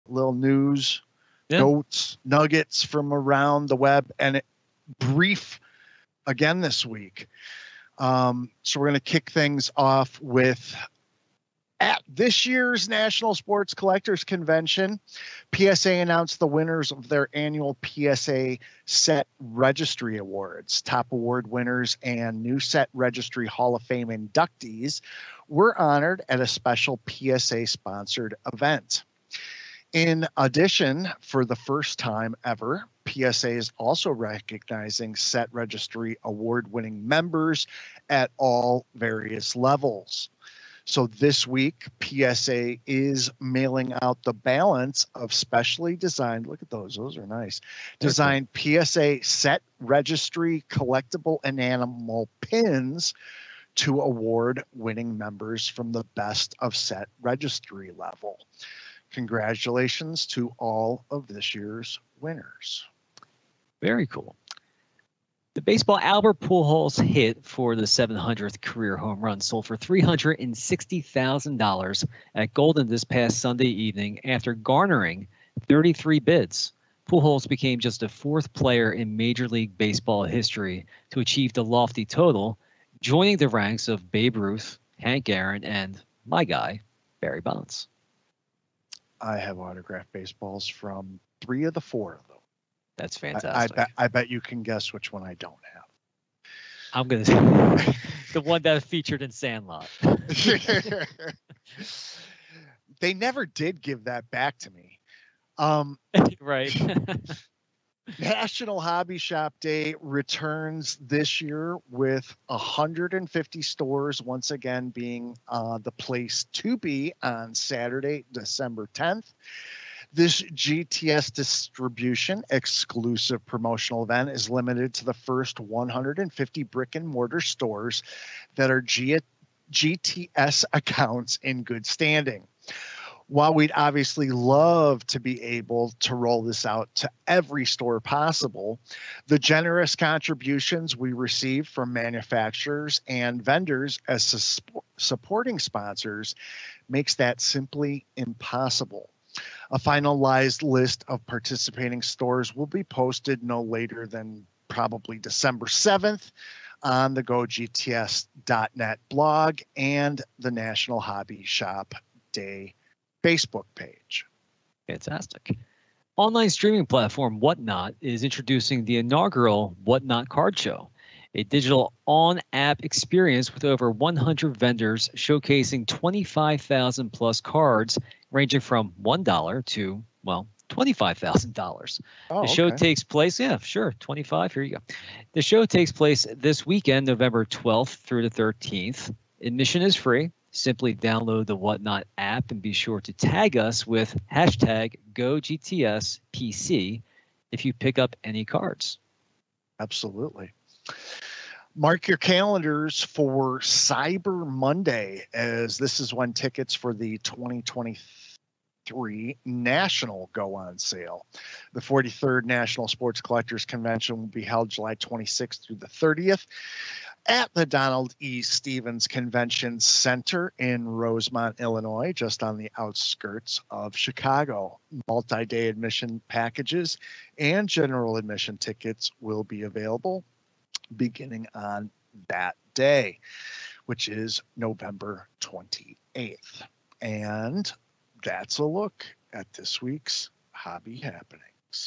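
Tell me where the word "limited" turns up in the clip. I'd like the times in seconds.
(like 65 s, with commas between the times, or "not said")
124 s.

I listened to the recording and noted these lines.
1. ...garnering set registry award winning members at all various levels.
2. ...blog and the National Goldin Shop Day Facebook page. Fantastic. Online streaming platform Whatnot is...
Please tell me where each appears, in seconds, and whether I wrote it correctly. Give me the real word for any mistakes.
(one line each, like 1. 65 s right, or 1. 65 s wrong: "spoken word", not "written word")
1. 34 s wrong: "recognizing", not "garnering"
2. 159 s wrong: "Hobby", not "Goldin".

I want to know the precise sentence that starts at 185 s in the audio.
The show takes place this weekend, November twelfth through the thirteenth.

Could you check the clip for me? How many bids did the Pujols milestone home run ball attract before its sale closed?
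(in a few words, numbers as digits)
33.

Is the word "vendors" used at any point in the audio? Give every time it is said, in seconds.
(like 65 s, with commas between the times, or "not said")
143 s, 174 s.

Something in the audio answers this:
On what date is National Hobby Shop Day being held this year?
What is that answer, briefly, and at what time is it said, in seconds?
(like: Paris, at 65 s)
December 10th, at 118 s.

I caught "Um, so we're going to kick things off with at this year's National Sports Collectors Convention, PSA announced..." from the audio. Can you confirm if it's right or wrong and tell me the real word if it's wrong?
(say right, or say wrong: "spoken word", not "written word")
right.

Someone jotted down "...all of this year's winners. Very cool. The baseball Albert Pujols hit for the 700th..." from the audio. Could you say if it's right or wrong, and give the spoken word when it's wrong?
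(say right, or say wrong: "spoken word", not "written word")
right.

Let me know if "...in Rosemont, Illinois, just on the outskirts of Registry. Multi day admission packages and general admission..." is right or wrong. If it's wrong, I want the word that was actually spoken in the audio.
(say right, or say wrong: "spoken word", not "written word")
wrong: "Chicago", not "Registry".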